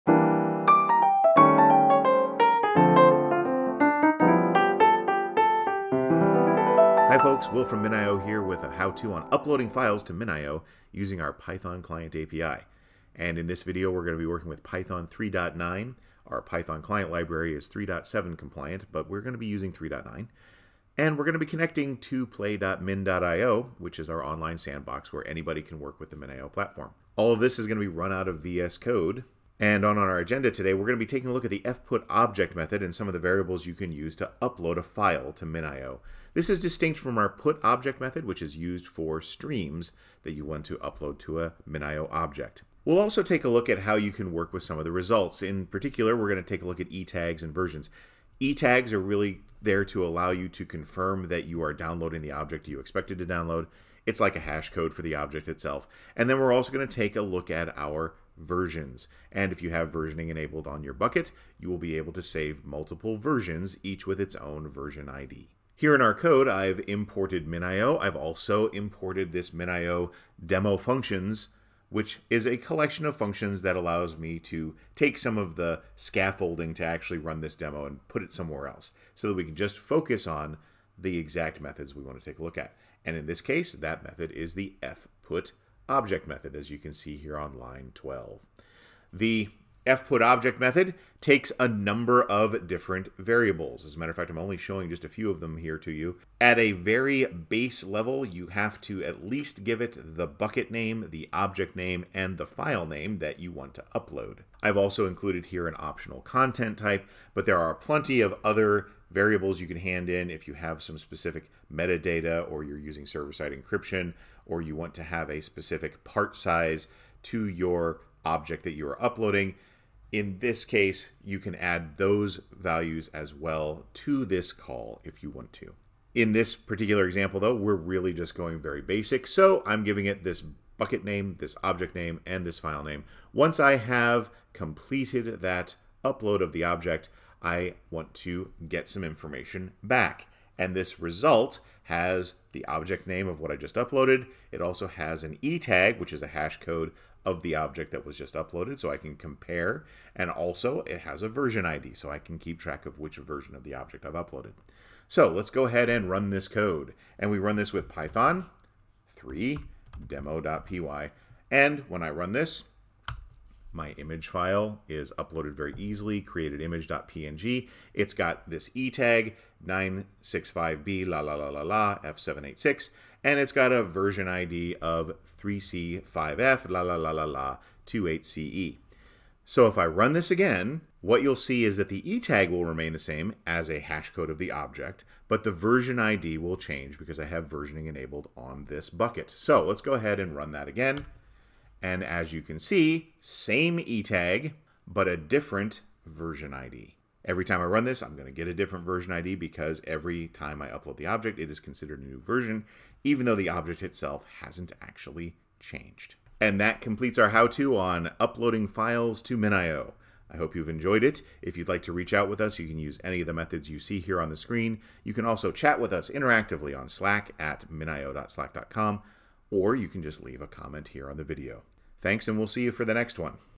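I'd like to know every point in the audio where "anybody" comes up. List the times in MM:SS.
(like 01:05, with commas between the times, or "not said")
00:25.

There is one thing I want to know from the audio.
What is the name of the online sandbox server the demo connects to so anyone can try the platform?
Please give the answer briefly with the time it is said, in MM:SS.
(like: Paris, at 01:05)
play.min.io, at 00:22.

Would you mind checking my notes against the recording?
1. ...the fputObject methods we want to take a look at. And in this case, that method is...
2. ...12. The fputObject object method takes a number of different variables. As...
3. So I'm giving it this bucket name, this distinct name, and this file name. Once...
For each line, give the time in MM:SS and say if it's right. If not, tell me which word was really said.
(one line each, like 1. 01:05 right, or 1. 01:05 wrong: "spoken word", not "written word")
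1. 01:20 wrong: "exact", not "fputObject"
2. 01:27 right
3. 02:09 wrong: "object", not "distinct".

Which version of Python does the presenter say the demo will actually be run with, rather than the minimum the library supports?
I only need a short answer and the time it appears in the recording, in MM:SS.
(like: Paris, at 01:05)
Python 3.9, at 00:14.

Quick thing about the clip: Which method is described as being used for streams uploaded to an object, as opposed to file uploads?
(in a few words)
put object.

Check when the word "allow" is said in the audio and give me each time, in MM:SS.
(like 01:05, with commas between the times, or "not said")
00:50, 01:13.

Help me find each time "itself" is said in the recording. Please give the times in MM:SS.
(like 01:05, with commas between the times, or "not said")
00:55, 03:23.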